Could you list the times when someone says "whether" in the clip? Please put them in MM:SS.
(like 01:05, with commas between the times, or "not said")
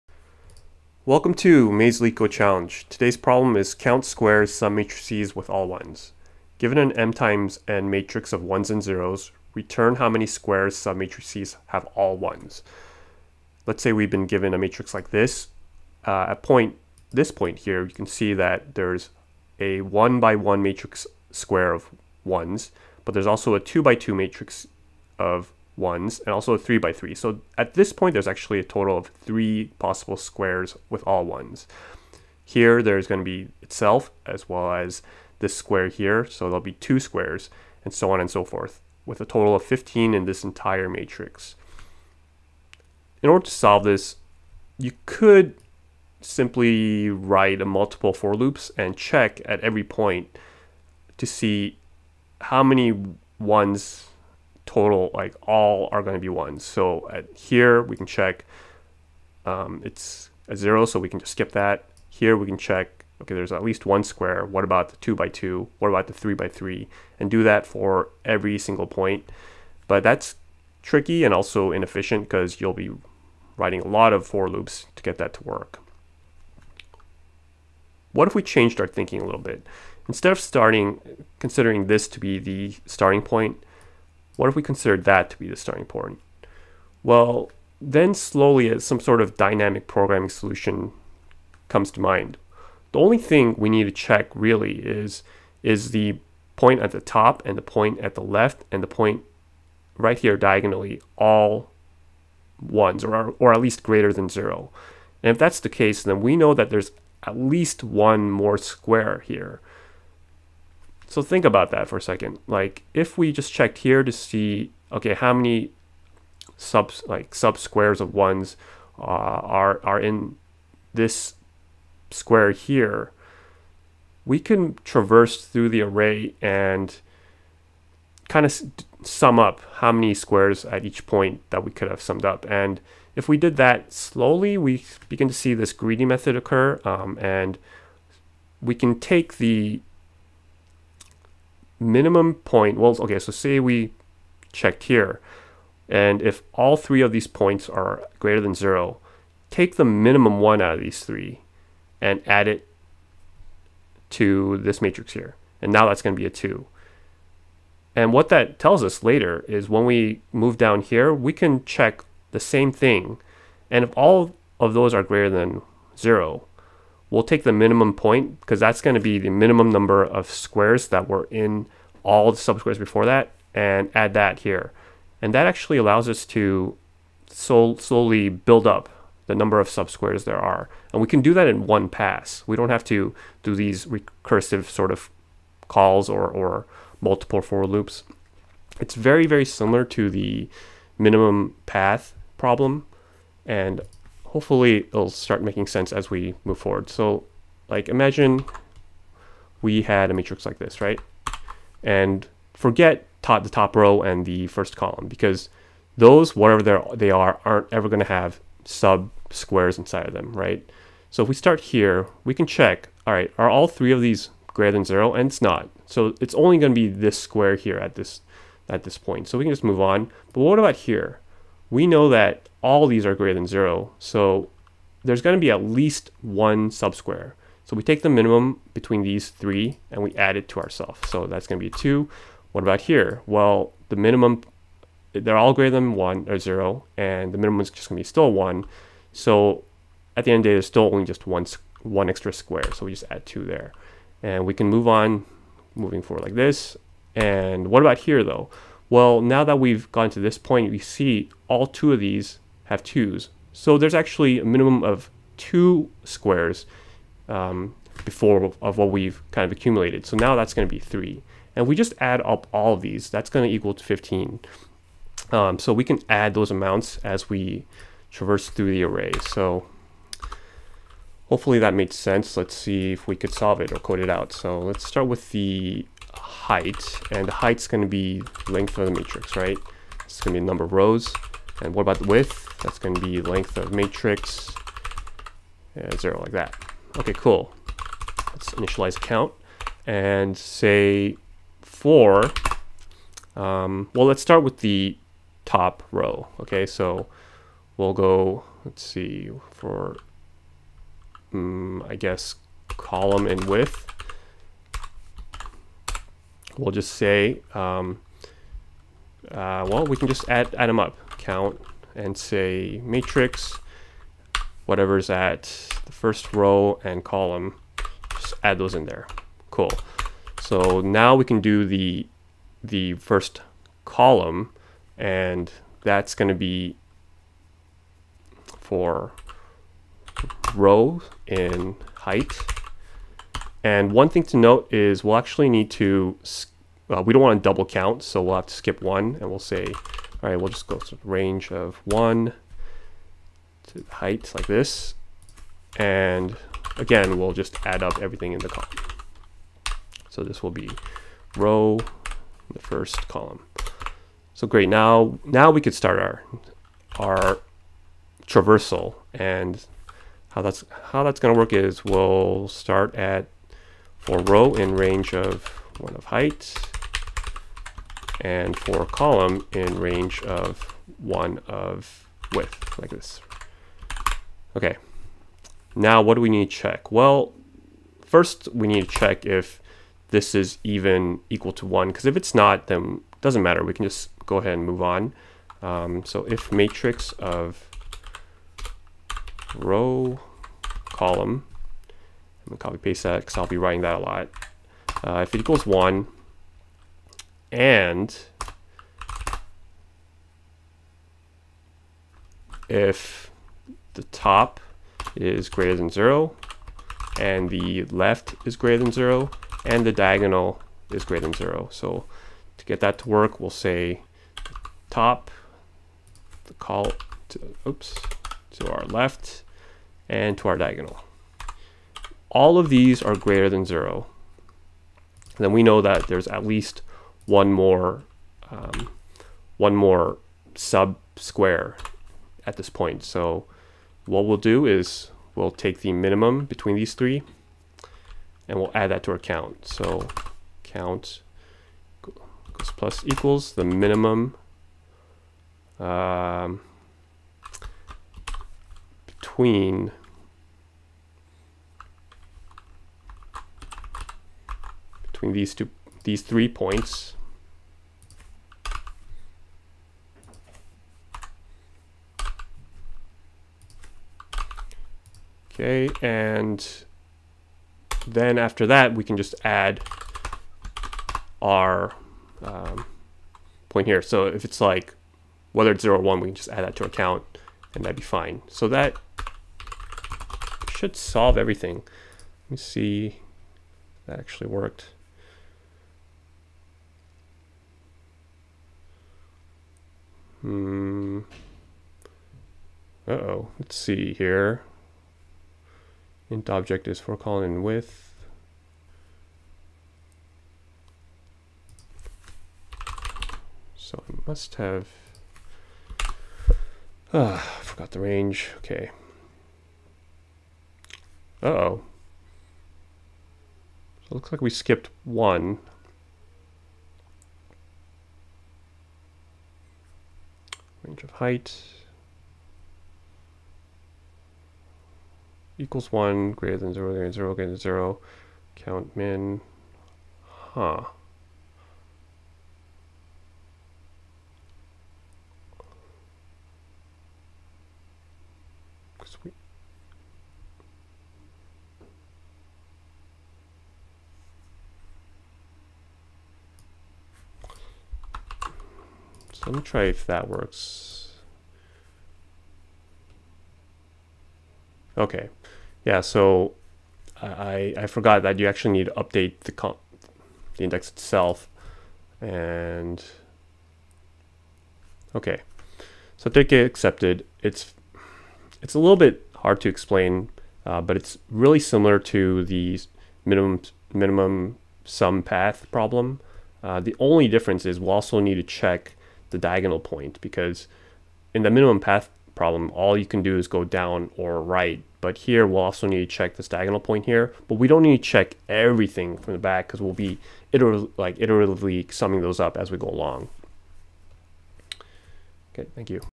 07:55.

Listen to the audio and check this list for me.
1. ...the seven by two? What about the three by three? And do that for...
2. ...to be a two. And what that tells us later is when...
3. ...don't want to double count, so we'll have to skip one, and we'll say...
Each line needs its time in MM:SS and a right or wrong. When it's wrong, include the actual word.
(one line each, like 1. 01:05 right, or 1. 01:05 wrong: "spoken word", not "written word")
1. 01:04 wrong: "two", not "seven"
2. 02:36 right
3. 05:37 right.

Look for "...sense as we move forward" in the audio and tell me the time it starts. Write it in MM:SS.
03:15.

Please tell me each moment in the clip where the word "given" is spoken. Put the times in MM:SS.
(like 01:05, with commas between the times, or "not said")
00:06, 00:14.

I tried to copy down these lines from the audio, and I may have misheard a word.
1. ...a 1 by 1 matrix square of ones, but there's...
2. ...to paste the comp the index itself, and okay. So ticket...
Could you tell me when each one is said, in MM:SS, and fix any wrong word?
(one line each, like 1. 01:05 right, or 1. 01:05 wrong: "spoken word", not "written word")
1. 00:19 right
2. 09:18 wrong: "update", not "paste".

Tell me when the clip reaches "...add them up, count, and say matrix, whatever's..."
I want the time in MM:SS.
05:10.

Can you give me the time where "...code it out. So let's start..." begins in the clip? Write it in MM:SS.
04:33.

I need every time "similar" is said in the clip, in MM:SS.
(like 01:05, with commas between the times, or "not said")
03:09, 09:31.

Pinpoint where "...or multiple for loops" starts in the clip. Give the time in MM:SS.
03:06.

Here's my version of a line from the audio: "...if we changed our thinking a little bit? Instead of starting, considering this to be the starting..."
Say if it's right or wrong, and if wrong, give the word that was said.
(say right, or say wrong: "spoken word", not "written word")
right.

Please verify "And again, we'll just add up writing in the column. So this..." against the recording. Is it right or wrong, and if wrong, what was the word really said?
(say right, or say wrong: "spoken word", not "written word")
wrong: "everything", not "writing".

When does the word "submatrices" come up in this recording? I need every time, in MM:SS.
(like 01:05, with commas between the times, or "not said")
00:04.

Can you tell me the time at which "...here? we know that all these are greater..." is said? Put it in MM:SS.
03:40.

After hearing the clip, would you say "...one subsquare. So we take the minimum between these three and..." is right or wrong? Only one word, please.
right.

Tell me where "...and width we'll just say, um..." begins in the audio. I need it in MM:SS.
05:03.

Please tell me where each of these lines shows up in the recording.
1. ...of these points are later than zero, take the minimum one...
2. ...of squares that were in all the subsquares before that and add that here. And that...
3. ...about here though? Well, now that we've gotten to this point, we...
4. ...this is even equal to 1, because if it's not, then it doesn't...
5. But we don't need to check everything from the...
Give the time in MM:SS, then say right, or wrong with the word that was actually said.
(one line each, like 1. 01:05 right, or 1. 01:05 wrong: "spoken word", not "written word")
1. 02:27 wrong: "greater", not "later"
2. 02:50 right
3. 04:07 right
4. 06:20 right
5. 09:47 right.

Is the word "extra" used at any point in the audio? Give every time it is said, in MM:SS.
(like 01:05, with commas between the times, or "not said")
04:02.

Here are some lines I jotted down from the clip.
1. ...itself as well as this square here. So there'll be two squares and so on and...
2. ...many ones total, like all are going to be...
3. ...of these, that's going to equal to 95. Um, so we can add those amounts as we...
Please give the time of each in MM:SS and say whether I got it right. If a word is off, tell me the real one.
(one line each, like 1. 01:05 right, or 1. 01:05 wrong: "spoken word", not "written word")
1. 00:33 right
2. 00:52 right
3. 04:22 wrong: "15", not "95".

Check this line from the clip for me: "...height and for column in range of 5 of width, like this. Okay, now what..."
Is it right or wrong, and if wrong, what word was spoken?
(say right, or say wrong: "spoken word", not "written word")
wrong: "1", not "5".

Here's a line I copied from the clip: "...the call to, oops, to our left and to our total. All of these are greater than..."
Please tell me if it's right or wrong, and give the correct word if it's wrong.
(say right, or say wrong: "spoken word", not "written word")
wrong: "diagonal", not "total".